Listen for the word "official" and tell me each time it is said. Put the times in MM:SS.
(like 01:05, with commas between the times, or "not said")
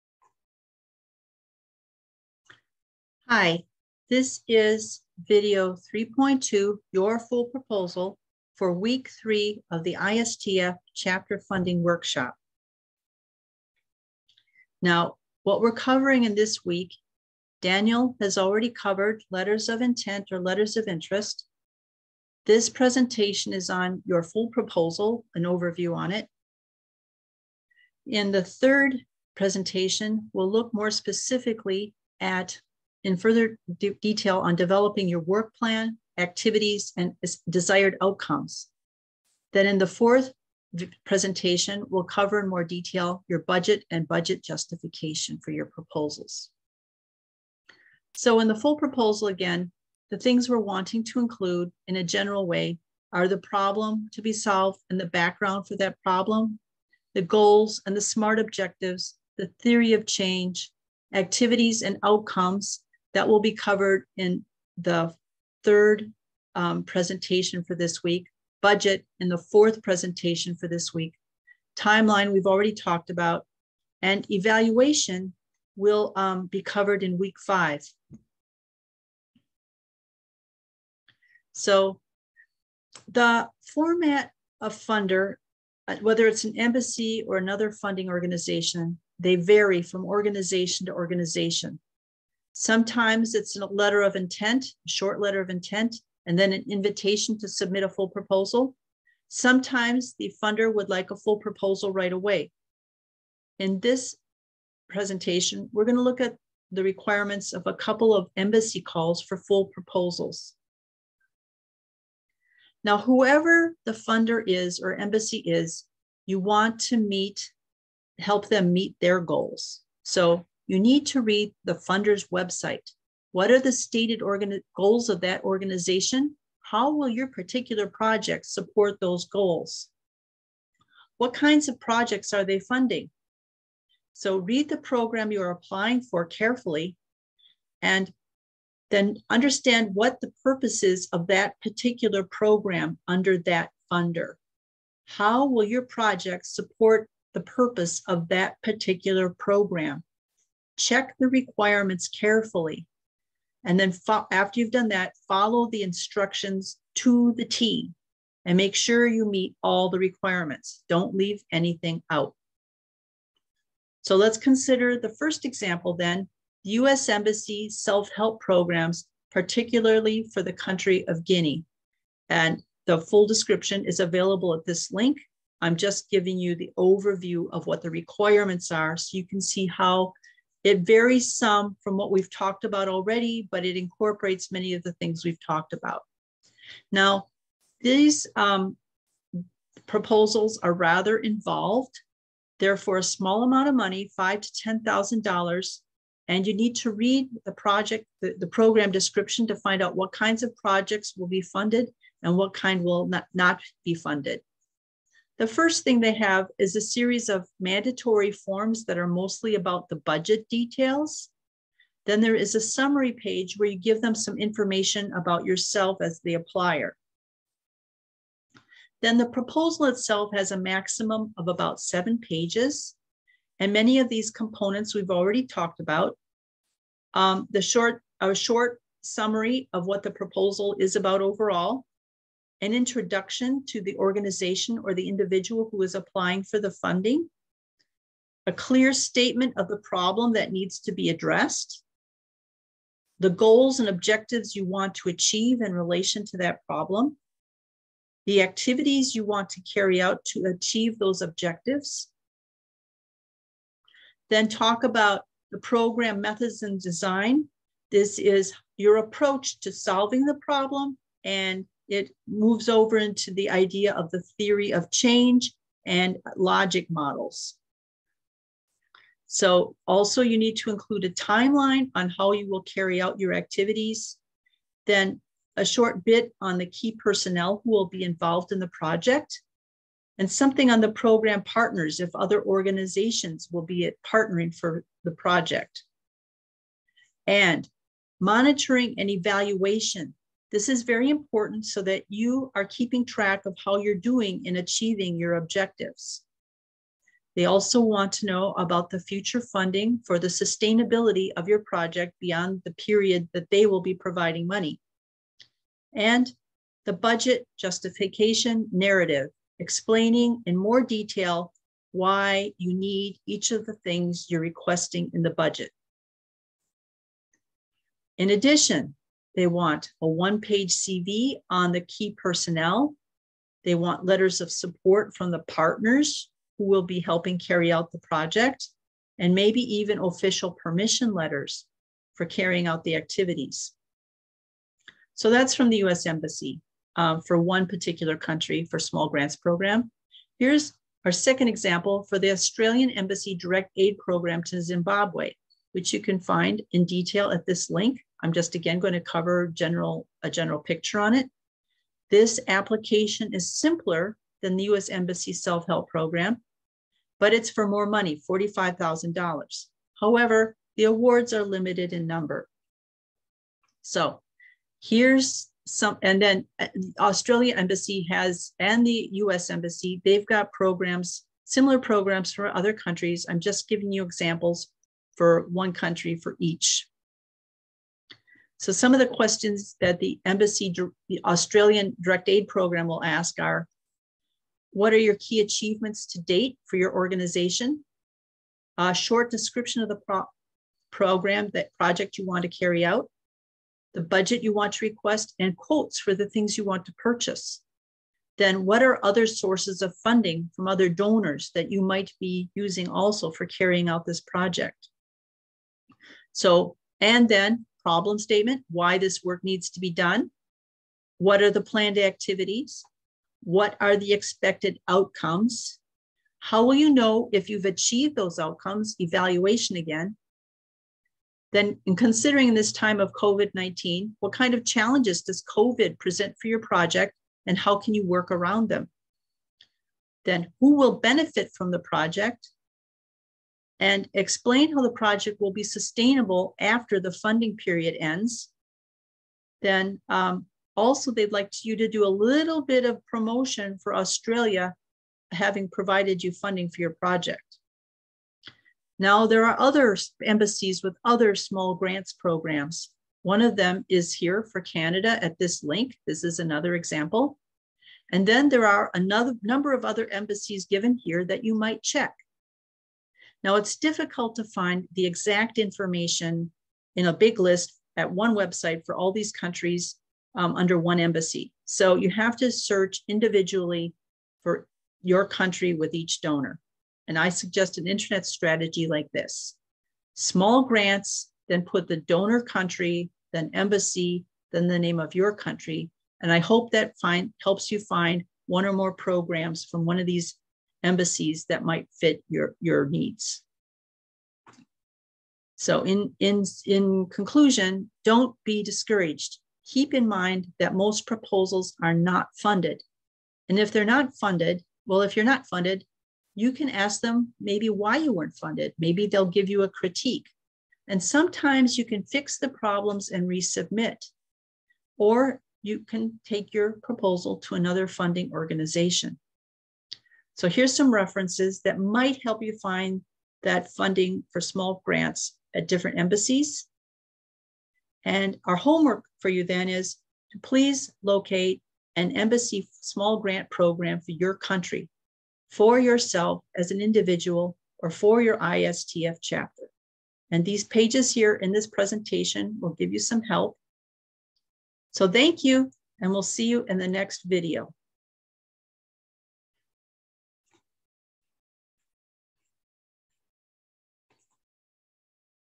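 05:29.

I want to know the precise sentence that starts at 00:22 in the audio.
This presentation is on your full proposal, an overview on it.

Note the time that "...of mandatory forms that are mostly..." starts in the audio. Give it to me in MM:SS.
03:27.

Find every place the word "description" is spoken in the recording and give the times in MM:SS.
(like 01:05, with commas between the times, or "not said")
02:53, 03:18, 06:29.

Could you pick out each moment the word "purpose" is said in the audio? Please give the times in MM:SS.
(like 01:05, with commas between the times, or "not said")
02:20, 02:27.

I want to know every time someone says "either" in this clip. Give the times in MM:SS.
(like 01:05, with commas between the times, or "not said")
not said.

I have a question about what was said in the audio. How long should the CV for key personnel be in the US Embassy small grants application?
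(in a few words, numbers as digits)
1 page.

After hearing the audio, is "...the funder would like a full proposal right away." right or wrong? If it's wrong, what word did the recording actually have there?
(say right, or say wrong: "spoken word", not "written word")
right.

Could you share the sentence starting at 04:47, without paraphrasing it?
And monitoring and evaluation this is very important so that you are keeping track of how you're doing in achieving your objectives.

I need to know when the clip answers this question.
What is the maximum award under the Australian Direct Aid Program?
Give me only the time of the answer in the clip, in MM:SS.
05:58.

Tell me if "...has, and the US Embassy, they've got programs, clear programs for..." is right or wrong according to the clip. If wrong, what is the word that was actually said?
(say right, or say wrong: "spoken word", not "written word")
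wrong: "similar", not "clear".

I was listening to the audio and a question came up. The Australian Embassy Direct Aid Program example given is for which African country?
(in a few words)
Zimbabwe.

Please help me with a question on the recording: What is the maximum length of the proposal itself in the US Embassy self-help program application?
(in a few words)
7 pages.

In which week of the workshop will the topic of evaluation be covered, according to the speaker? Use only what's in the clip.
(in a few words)
week 5.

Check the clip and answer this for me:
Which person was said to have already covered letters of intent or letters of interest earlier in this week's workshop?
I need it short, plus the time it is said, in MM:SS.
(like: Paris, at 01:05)
Daniel, at 00:17.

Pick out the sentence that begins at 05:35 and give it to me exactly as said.
So that's from the US Embassy um, for one particular country for small grants program.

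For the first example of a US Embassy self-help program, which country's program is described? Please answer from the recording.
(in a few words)
Guinea.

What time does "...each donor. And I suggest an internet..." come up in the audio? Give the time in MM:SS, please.
07:55.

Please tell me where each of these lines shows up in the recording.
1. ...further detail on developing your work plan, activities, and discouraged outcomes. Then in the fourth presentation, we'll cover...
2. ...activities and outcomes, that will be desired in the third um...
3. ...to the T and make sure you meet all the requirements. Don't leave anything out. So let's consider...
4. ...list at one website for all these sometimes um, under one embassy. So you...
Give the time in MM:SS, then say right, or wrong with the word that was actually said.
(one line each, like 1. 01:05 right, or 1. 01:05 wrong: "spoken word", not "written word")
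1. 00:33 wrong: "desired", not "discouraged"
2. 01:01 wrong: "covered", not "desired"
3. 02:36 right
4. 07:47 wrong: "countries", not "sometimes".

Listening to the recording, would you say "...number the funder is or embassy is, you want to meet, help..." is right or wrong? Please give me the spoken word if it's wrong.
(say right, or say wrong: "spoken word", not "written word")
wrong: "whoever", not "number".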